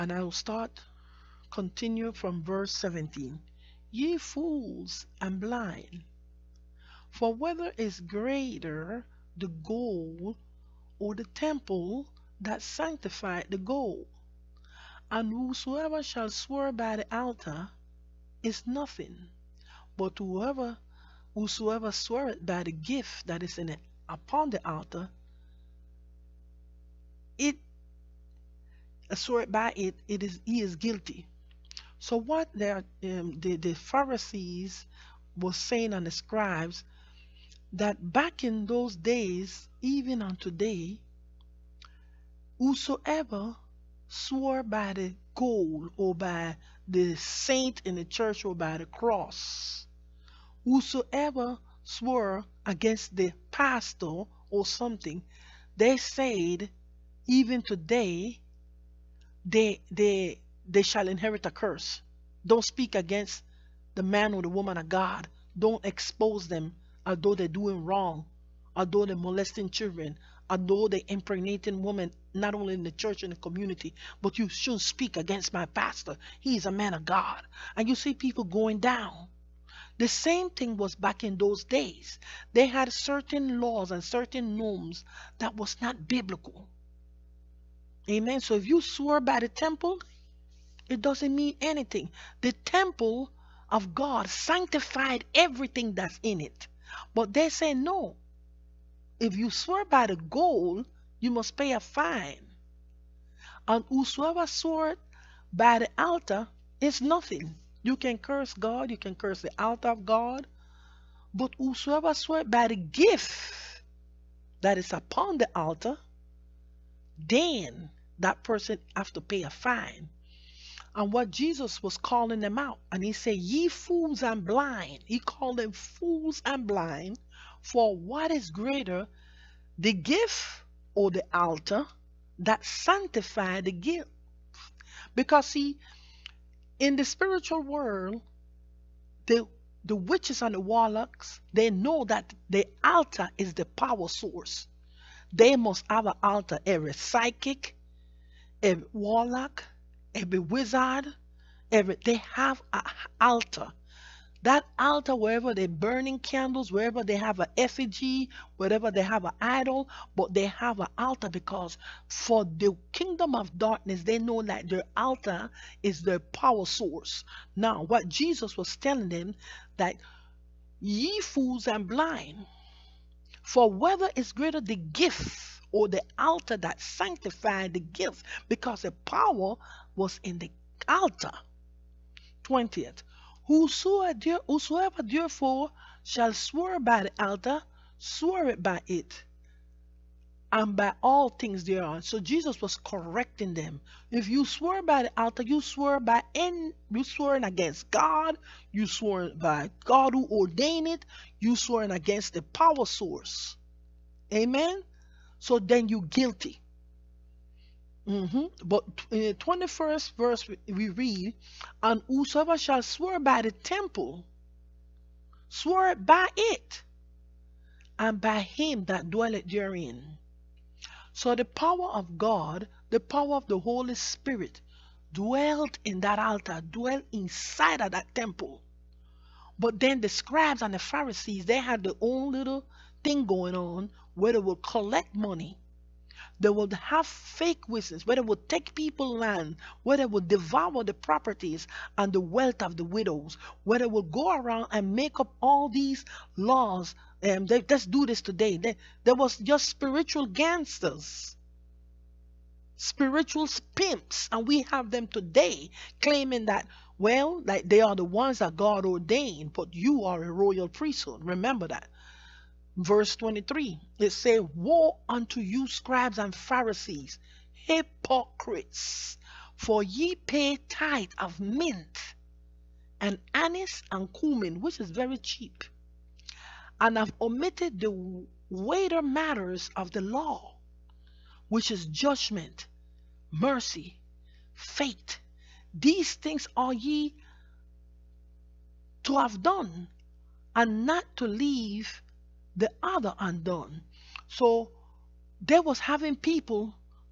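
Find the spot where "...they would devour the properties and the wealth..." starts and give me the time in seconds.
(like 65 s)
239 s.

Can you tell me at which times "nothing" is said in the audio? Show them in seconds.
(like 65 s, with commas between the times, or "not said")
18 s, 106 s.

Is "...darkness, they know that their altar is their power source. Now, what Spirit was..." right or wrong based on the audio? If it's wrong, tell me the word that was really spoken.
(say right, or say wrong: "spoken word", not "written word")
wrong: "Jesus", not "Spirit".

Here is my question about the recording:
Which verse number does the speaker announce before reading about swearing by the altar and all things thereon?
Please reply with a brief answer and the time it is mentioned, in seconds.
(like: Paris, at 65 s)
20th, at 182 s.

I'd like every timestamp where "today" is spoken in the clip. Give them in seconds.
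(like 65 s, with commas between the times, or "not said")
40 s, 57 s, 248 s, 255 s.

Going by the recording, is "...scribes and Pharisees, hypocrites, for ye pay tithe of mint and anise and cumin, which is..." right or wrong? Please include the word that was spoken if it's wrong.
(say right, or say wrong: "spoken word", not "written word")
right.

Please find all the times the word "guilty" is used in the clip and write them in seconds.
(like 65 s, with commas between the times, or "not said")
30 s, 205 s.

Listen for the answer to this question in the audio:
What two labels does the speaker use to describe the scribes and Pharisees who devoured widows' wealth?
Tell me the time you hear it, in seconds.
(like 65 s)
249 s.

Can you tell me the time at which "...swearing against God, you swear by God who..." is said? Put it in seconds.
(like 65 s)
197 s.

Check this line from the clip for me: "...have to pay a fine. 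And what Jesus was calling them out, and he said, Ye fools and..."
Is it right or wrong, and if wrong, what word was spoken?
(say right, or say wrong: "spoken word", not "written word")
right.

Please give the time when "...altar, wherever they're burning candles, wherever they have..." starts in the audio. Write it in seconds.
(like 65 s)
154 s.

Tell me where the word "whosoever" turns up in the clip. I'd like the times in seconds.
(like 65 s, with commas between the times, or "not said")
15 s, 21 s, 42 s, 50 s, 103 s, 111 s, 183 s, 212 s.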